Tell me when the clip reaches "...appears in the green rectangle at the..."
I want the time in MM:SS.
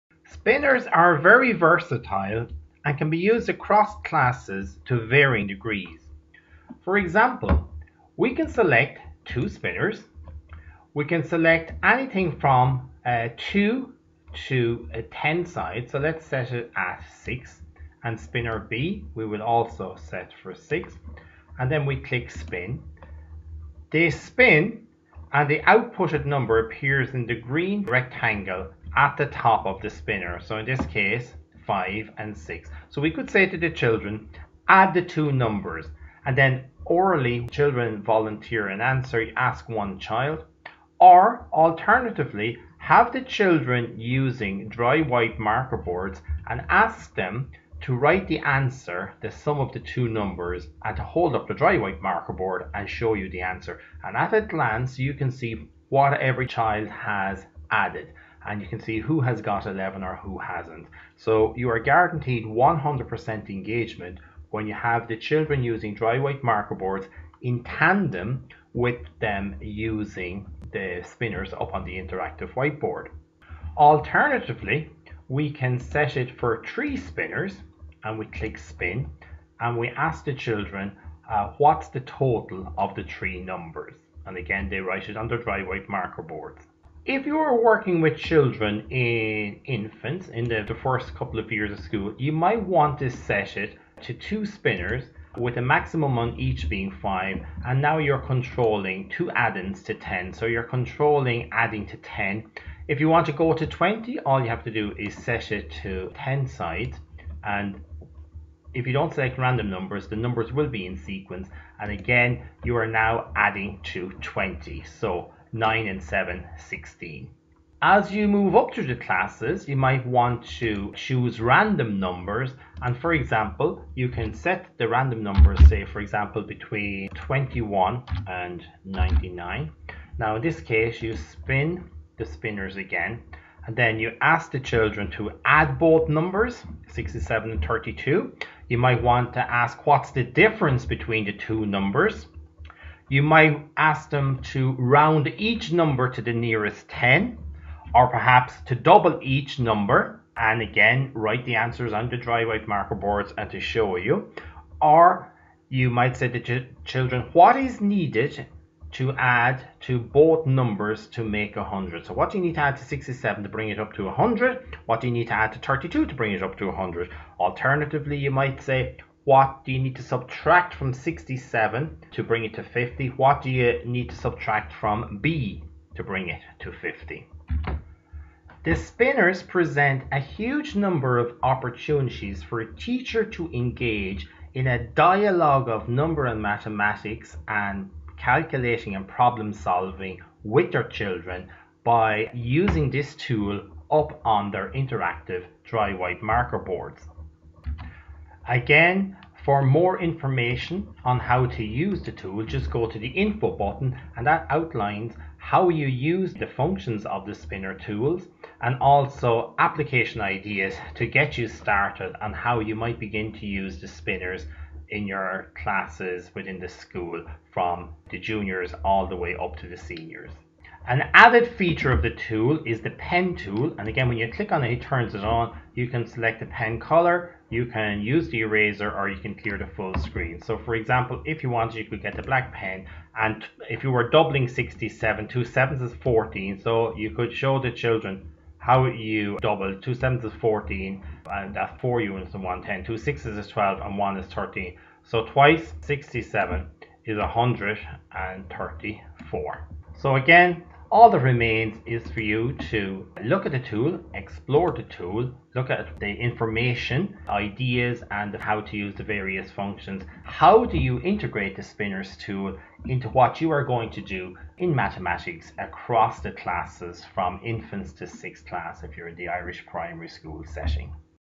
00:26.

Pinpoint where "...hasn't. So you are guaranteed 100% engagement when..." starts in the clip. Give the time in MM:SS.
01:00.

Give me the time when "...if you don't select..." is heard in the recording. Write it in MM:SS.
01:48.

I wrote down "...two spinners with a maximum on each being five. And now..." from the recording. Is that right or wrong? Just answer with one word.
right.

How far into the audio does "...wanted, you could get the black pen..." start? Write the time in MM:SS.
03:51.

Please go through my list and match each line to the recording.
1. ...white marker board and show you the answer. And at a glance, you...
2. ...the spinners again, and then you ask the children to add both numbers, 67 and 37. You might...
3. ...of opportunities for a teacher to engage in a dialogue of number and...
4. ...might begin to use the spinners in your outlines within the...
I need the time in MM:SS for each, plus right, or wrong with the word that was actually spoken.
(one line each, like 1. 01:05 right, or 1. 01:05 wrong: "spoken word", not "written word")
1. 00:51 right
2. 02:12 wrong: "32", not "37"
3. 03:01 right
4. 03:32 wrong: "classes", not "outlines".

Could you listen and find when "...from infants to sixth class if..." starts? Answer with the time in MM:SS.
04:27.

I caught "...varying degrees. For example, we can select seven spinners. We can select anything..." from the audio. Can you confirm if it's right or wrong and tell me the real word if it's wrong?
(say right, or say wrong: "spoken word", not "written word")
wrong: "two", not "seven".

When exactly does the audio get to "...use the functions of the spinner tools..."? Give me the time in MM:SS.
03:25.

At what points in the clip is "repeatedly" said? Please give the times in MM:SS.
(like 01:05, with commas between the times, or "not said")
not said.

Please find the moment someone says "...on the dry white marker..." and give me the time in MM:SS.
02:31.